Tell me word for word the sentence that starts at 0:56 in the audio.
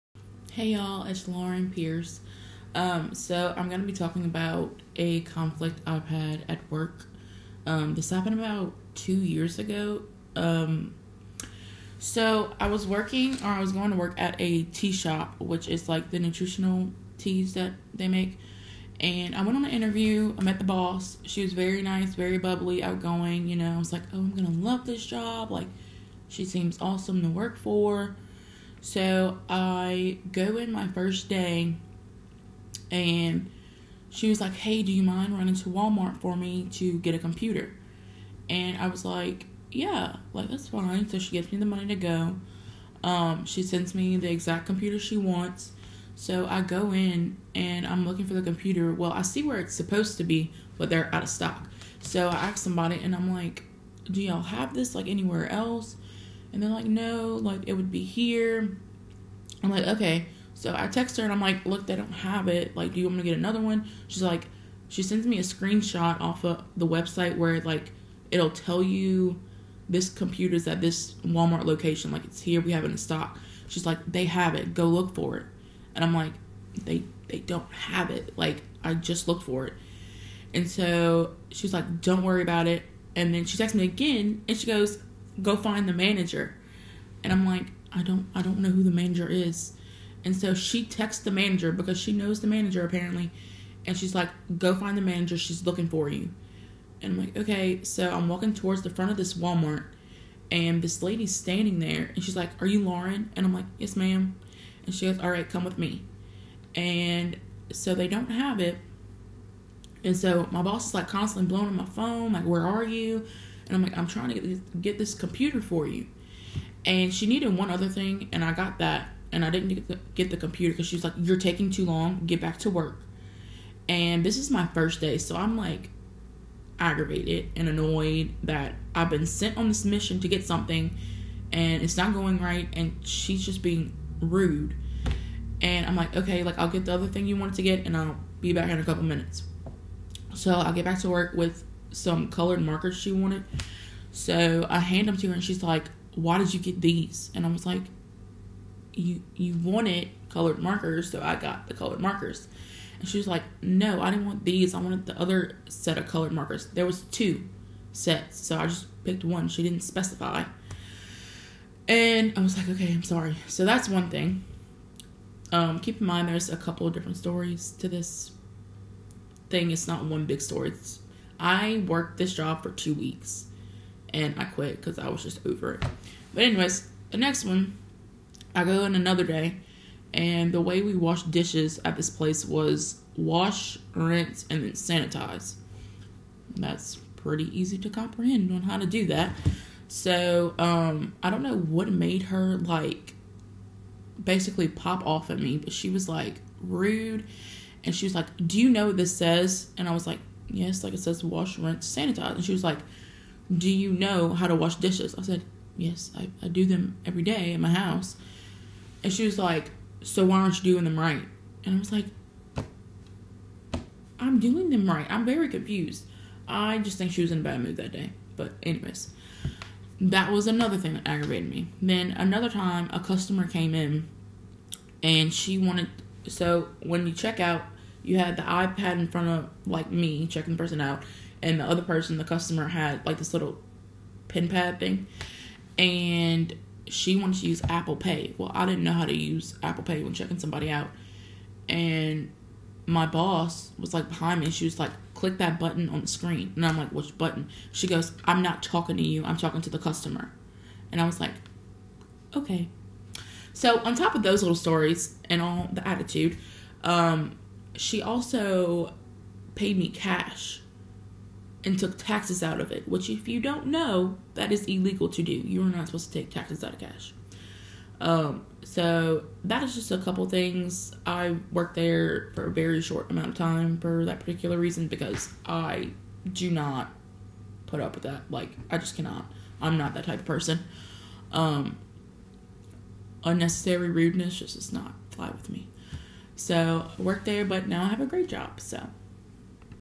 And they're like, no, like it would be here.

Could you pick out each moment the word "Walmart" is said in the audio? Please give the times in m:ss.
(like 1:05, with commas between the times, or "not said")
0:35, 1:11, 1:39.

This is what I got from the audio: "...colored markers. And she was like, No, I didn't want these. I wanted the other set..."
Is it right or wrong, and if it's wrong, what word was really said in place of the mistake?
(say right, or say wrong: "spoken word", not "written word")
right.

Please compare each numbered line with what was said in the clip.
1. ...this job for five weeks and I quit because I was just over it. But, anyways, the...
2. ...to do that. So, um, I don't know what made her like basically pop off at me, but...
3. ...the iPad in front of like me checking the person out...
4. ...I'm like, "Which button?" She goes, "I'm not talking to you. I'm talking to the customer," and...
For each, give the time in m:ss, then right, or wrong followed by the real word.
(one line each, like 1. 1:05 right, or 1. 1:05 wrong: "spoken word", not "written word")
1. 2:52 wrong: "two", not "five"
2. 3:08 right
3. 3:48 right
4. 4:06 right.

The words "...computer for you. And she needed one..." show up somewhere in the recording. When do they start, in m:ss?
1:55.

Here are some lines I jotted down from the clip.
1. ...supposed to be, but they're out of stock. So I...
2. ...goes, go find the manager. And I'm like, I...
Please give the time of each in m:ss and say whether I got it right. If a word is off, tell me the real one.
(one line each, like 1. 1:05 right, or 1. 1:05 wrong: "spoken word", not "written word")
1. 0:49 right
2. 1:24 right.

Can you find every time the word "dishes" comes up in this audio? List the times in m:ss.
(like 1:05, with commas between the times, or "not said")
3:01, 3:24.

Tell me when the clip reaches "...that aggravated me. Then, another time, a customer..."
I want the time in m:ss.
3:40.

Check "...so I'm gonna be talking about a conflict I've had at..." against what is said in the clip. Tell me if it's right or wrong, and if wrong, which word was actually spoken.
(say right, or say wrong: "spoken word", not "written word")
right.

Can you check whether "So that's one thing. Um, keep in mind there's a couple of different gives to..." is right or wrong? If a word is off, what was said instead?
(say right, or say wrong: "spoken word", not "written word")
wrong: "stories", not "gives".